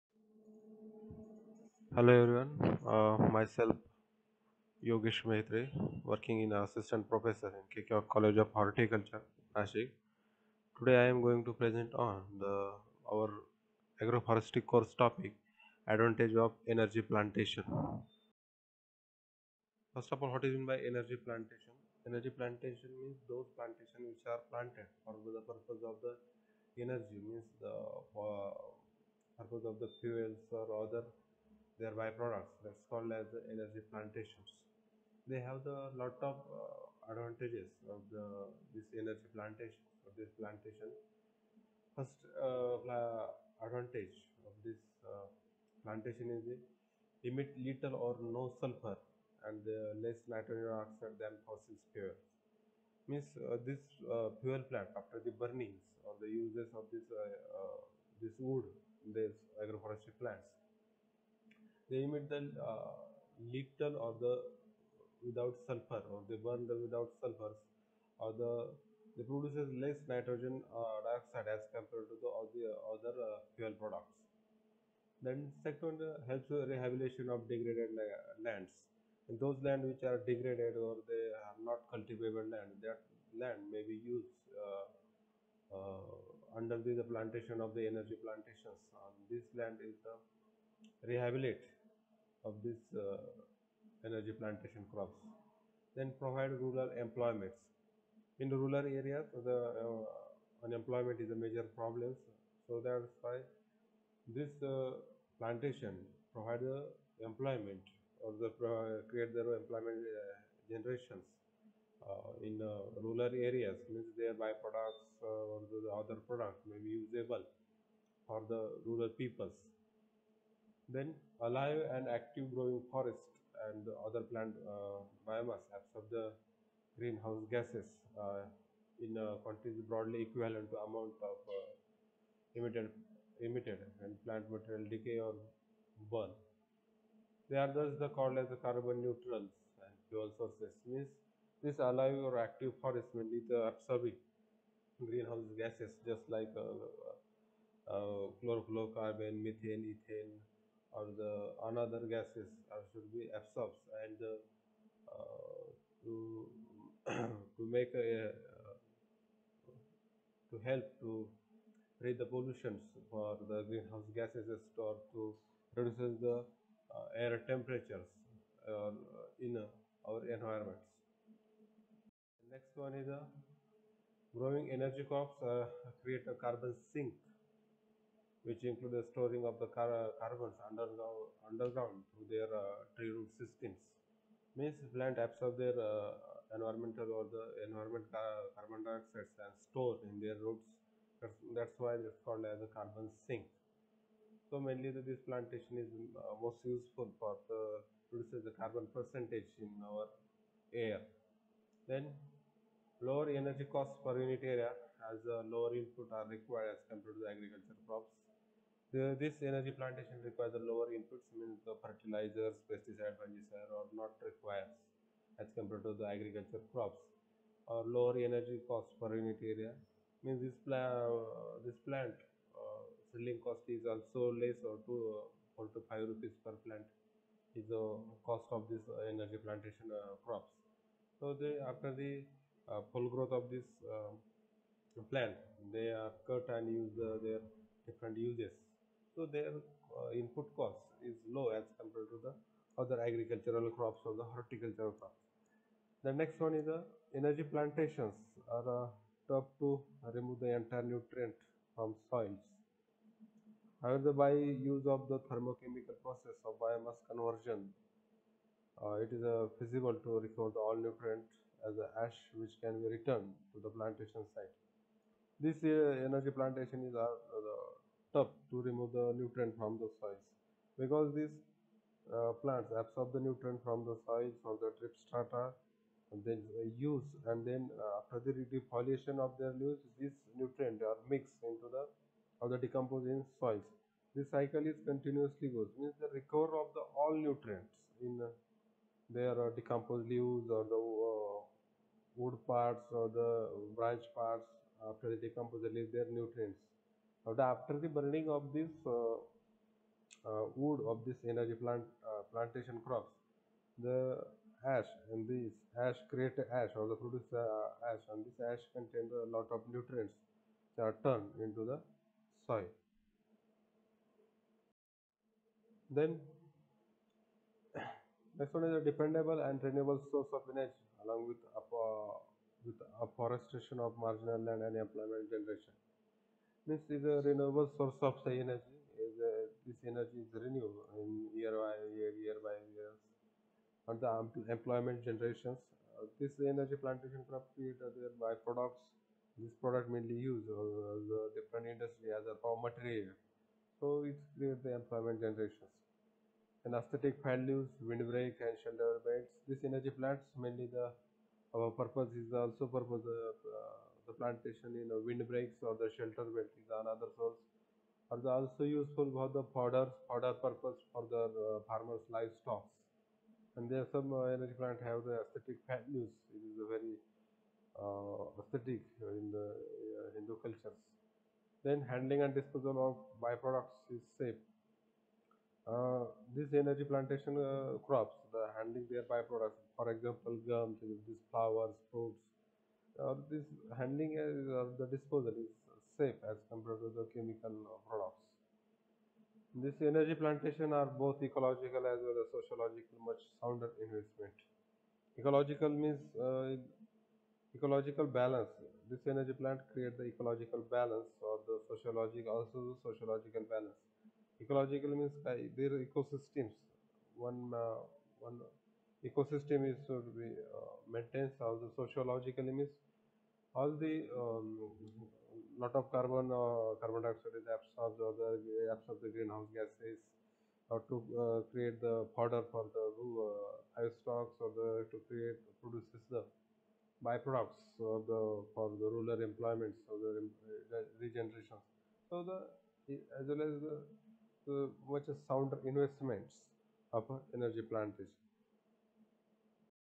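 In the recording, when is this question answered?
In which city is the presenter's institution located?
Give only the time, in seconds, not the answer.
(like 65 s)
9 s.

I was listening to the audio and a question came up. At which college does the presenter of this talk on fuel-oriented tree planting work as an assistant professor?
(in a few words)
KK College of Horticulture.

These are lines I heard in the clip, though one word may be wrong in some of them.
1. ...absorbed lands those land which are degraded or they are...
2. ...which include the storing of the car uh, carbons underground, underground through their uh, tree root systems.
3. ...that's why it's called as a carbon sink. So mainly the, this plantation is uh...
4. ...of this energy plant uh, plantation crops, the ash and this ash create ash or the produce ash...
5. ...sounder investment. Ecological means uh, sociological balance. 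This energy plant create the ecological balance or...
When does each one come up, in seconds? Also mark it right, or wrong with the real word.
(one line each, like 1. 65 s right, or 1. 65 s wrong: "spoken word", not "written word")
1. 77 s wrong: "degraded", not "absorbed"
2. 178 s right
3. 191 s right
4. 300 s right
5. 393 s wrong: "ecological", not "sociological".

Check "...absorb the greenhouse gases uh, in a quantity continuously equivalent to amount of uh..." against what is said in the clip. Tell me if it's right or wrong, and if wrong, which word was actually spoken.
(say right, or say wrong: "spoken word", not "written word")
wrong: "broadly", not "continuously".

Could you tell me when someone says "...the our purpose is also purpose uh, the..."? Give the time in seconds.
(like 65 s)
350 s.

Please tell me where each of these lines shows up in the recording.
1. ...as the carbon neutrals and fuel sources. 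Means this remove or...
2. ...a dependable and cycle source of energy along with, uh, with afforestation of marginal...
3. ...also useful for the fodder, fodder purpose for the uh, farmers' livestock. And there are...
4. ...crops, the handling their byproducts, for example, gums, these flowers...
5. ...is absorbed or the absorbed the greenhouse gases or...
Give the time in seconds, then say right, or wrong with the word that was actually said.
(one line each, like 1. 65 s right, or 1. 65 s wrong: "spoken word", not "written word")
1. 138 s wrong: "alive", not "remove"
2. 318 s wrong: "renewable", not "cycle"
3. 358 s right
4. 377 s right
5. 417 s right.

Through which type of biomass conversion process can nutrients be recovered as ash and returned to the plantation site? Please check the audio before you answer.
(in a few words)
Thermochemical process.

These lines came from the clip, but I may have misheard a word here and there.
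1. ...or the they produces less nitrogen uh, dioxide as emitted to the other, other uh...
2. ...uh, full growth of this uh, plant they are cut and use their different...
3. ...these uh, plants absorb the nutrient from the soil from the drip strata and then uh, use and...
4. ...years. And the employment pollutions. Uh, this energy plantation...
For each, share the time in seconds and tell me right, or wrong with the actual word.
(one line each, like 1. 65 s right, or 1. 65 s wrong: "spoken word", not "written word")
1. 68 s wrong: "compared", not "emitted"
2. 232 s right
3. 271 s right
4. 332 s wrong: "generations", not "pollutions".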